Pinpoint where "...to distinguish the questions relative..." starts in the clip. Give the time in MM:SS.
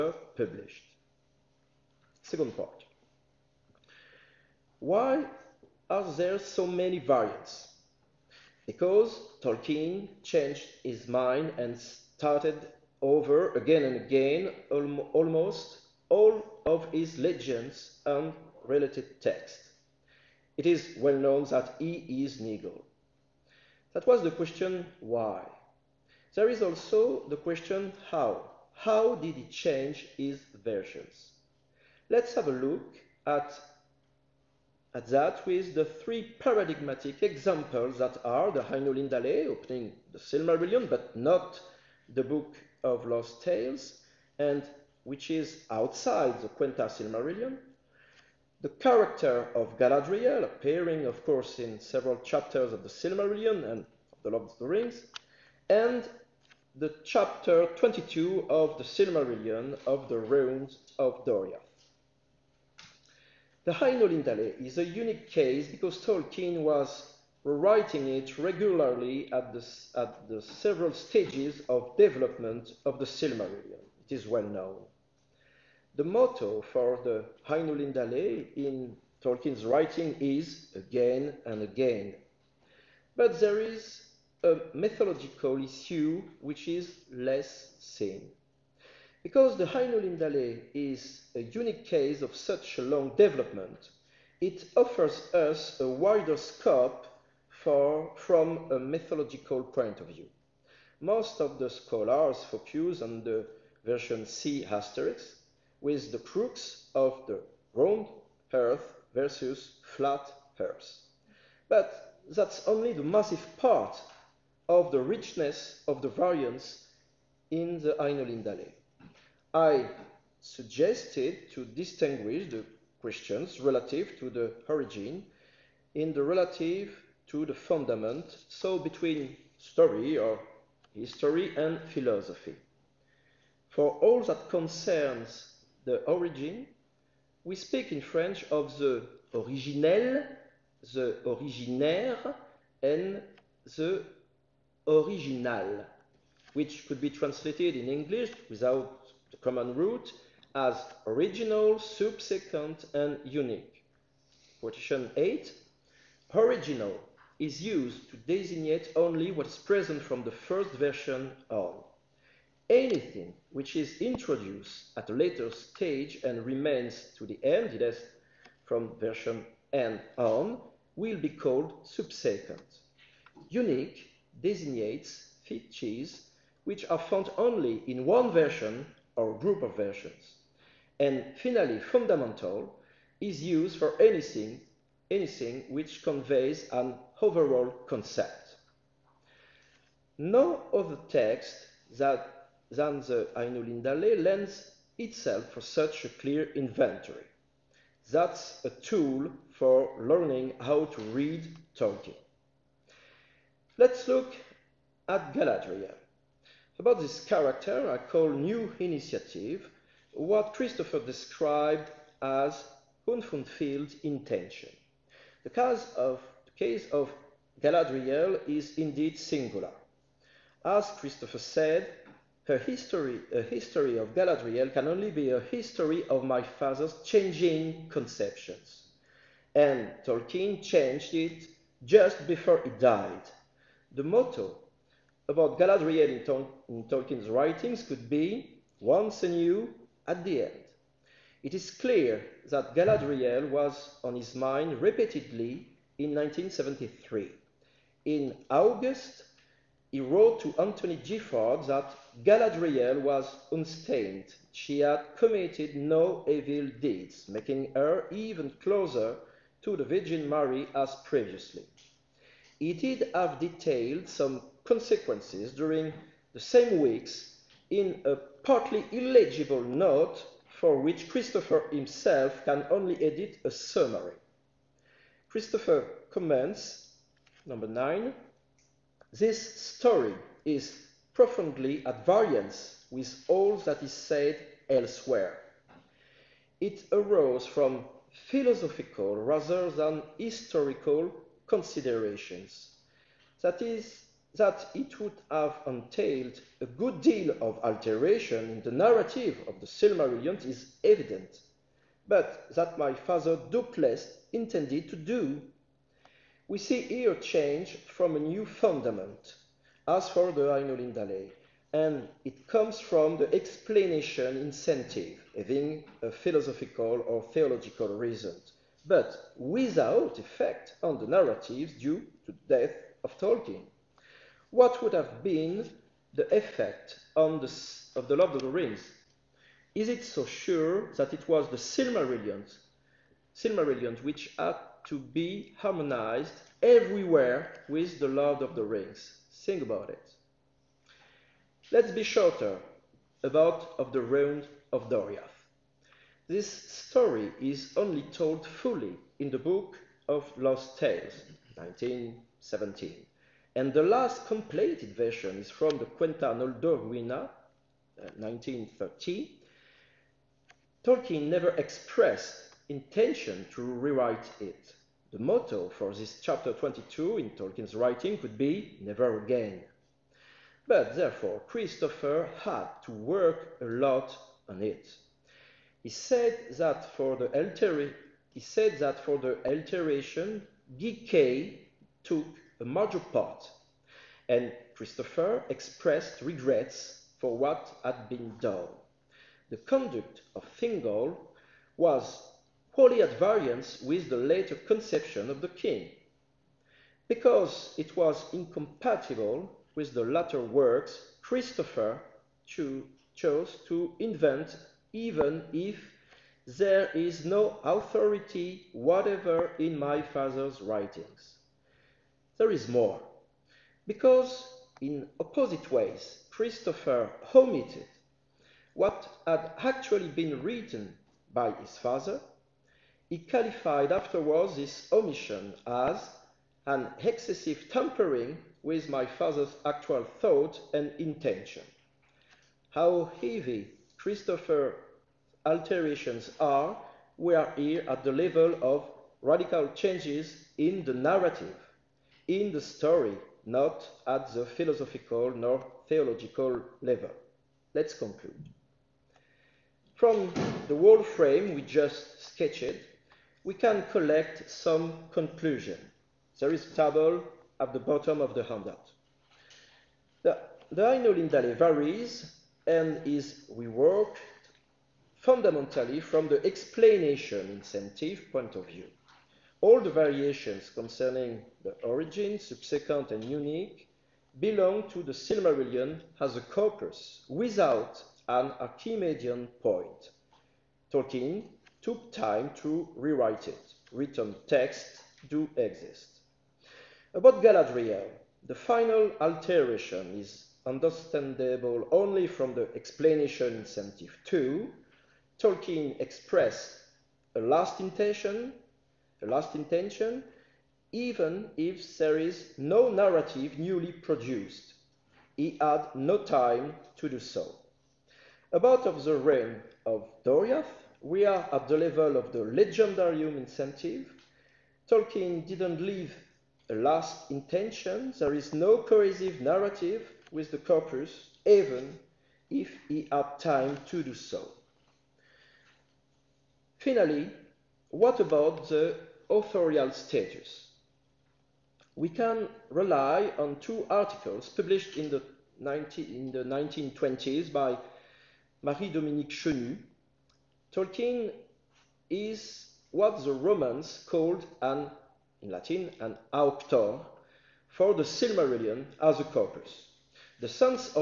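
02:01.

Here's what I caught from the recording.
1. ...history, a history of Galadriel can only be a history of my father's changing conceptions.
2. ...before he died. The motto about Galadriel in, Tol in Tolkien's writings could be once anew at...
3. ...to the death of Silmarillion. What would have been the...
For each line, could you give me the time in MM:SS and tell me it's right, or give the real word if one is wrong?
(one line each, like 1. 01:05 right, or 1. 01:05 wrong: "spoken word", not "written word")
1. 03:42 right
2. 03:52 right
3. 05:22 wrong: "Tolkien", not "Silmarillion".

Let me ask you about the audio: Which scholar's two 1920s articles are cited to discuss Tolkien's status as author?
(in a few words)
Marie-Dominique Chenu.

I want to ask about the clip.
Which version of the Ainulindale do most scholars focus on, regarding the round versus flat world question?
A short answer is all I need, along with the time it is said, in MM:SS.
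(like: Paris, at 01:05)
C asterisk, at 01:44.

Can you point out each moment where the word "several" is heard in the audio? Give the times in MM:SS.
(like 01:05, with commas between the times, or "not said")
00:51, 01:10.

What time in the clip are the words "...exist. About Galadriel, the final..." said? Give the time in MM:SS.
08:05.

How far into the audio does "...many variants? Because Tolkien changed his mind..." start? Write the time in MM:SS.
00:06.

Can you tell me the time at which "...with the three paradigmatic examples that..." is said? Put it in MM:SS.
00:35.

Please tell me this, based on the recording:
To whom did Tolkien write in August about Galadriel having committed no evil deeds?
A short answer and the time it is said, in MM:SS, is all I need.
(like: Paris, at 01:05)
Anthony Gifford, at 04:10.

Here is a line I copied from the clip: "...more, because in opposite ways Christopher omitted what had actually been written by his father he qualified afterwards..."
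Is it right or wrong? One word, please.
right.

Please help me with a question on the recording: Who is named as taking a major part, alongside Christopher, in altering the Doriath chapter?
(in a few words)
G.K.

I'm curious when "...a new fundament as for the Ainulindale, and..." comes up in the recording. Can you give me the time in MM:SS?
05:08.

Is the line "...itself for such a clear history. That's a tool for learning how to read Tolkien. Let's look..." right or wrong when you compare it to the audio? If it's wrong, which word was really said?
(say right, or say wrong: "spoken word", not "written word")
wrong: "inventory", not "history".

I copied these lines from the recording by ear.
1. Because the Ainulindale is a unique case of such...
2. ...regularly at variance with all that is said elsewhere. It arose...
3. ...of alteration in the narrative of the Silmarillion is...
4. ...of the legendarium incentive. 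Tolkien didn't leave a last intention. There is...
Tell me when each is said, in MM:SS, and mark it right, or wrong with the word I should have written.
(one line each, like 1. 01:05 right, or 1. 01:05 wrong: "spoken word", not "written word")
1. 01:29 right
2. 04:41 wrong: "profoundly", not "regularly"
3. 04:57 right
4. 08:32 right.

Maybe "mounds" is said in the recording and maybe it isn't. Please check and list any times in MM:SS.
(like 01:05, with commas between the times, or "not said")
not said.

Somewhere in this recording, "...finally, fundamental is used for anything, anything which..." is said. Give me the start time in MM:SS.
03:01.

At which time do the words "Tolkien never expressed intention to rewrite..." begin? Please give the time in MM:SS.
06:00.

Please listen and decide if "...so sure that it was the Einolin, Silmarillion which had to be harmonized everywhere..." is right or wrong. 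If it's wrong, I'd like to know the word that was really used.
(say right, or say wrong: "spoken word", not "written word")
wrong: "Silmarillion", not "Einolin".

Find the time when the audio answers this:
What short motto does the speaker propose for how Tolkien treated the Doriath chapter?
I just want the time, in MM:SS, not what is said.
06:08.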